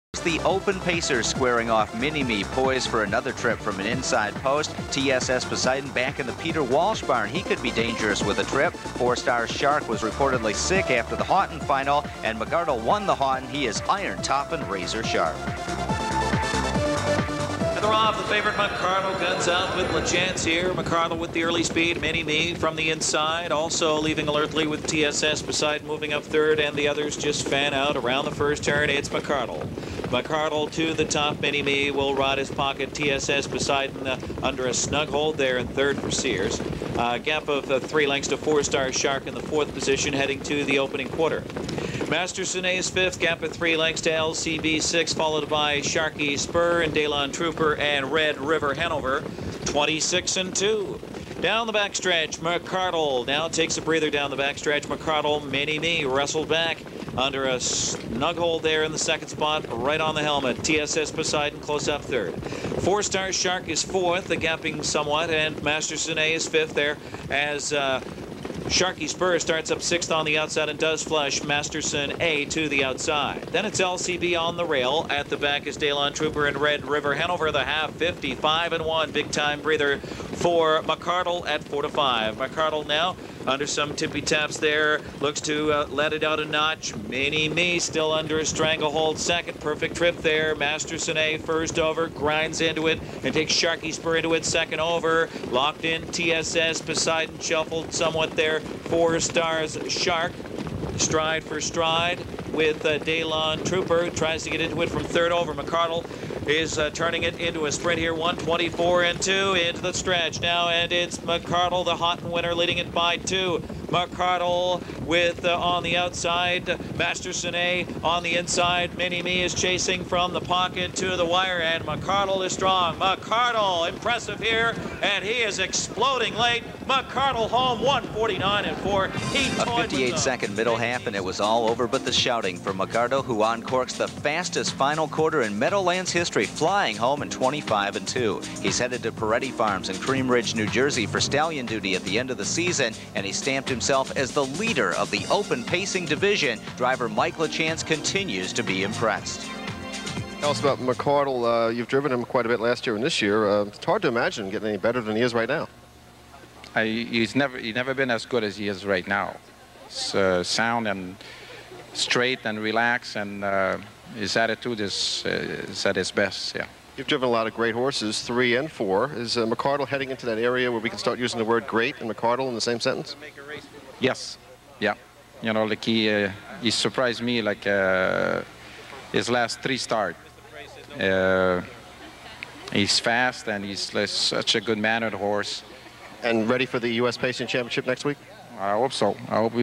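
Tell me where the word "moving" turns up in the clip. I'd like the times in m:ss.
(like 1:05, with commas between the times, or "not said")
0:25.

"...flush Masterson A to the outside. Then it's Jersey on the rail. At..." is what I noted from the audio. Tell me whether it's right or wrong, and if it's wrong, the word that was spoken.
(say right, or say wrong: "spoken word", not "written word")
wrong: "LCB", not "Jersey".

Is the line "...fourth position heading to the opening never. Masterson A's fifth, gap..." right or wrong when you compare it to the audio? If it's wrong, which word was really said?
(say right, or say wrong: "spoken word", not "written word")
wrong: "quarter", not "never".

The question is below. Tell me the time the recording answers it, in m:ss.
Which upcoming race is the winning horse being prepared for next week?
3:06.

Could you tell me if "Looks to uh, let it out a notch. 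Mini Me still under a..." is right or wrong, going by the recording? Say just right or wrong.
right.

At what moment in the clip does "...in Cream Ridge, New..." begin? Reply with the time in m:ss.
2:19.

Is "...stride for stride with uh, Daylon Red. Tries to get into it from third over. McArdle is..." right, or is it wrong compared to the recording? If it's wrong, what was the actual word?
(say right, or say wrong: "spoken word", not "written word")
wrong: "Trooper", not "Red".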